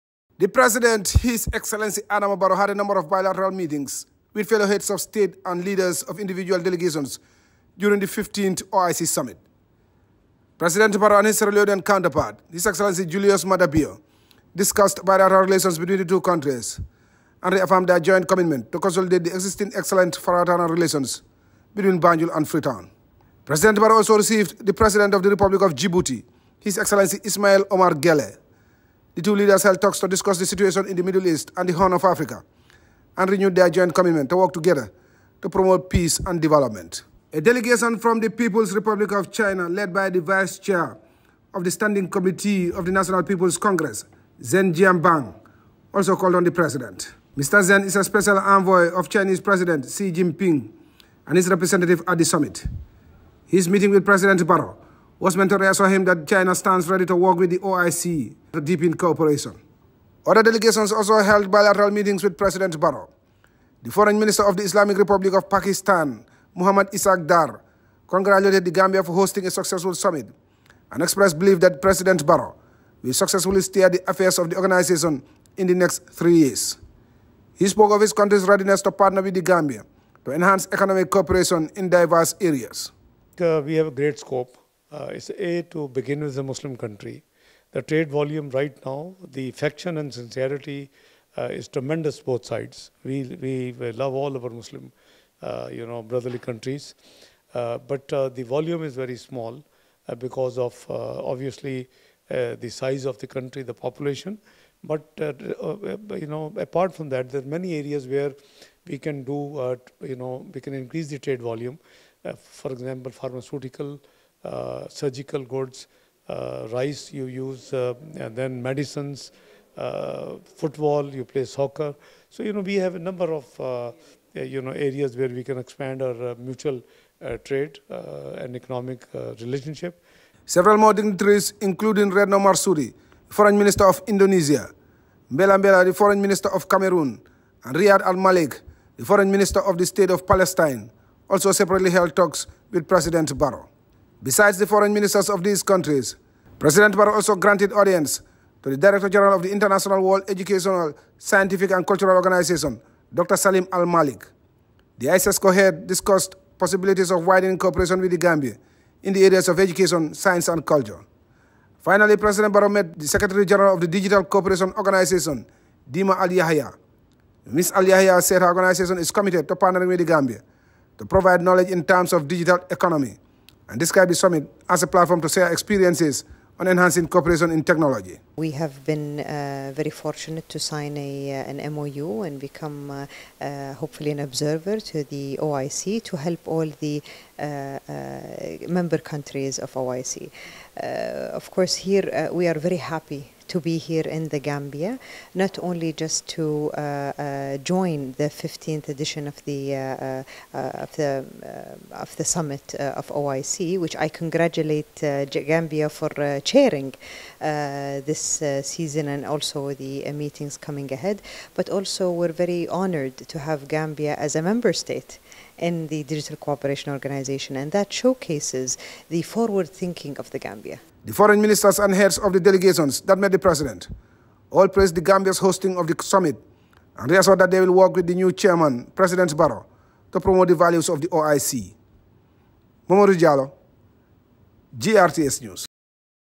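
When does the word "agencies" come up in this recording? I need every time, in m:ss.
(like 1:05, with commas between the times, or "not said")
not said.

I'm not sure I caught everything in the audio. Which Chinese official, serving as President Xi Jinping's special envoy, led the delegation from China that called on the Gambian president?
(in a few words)
Zheng Jianbang.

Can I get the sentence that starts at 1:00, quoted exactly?
Other delegations also held bilateral meetings with President Barrow.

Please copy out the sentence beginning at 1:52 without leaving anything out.
for example, pharmaceutical uh, surgical goods, uh, rice you use, uh, and then medicines, football, you play soccer.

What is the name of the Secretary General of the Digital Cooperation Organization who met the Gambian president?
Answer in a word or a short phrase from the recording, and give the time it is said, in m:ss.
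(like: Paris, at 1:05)
Dima Al Yahya, at 2:45.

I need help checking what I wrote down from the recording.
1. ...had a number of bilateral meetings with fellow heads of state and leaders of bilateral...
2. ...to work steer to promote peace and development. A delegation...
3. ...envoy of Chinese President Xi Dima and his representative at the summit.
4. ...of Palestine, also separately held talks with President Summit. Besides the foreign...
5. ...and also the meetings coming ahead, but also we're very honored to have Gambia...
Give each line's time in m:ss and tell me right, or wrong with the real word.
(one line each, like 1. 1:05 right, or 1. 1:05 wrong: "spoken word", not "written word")
1. 0:02 wrong: "individual", not "bilateral"
2. 0:34 wrong: "together", not "steer"
3. 0:48 wrong: "Jinping", not "Dima"
4. 2:20 wrong: "Barrow", not "Summit"
5. 3:29 right.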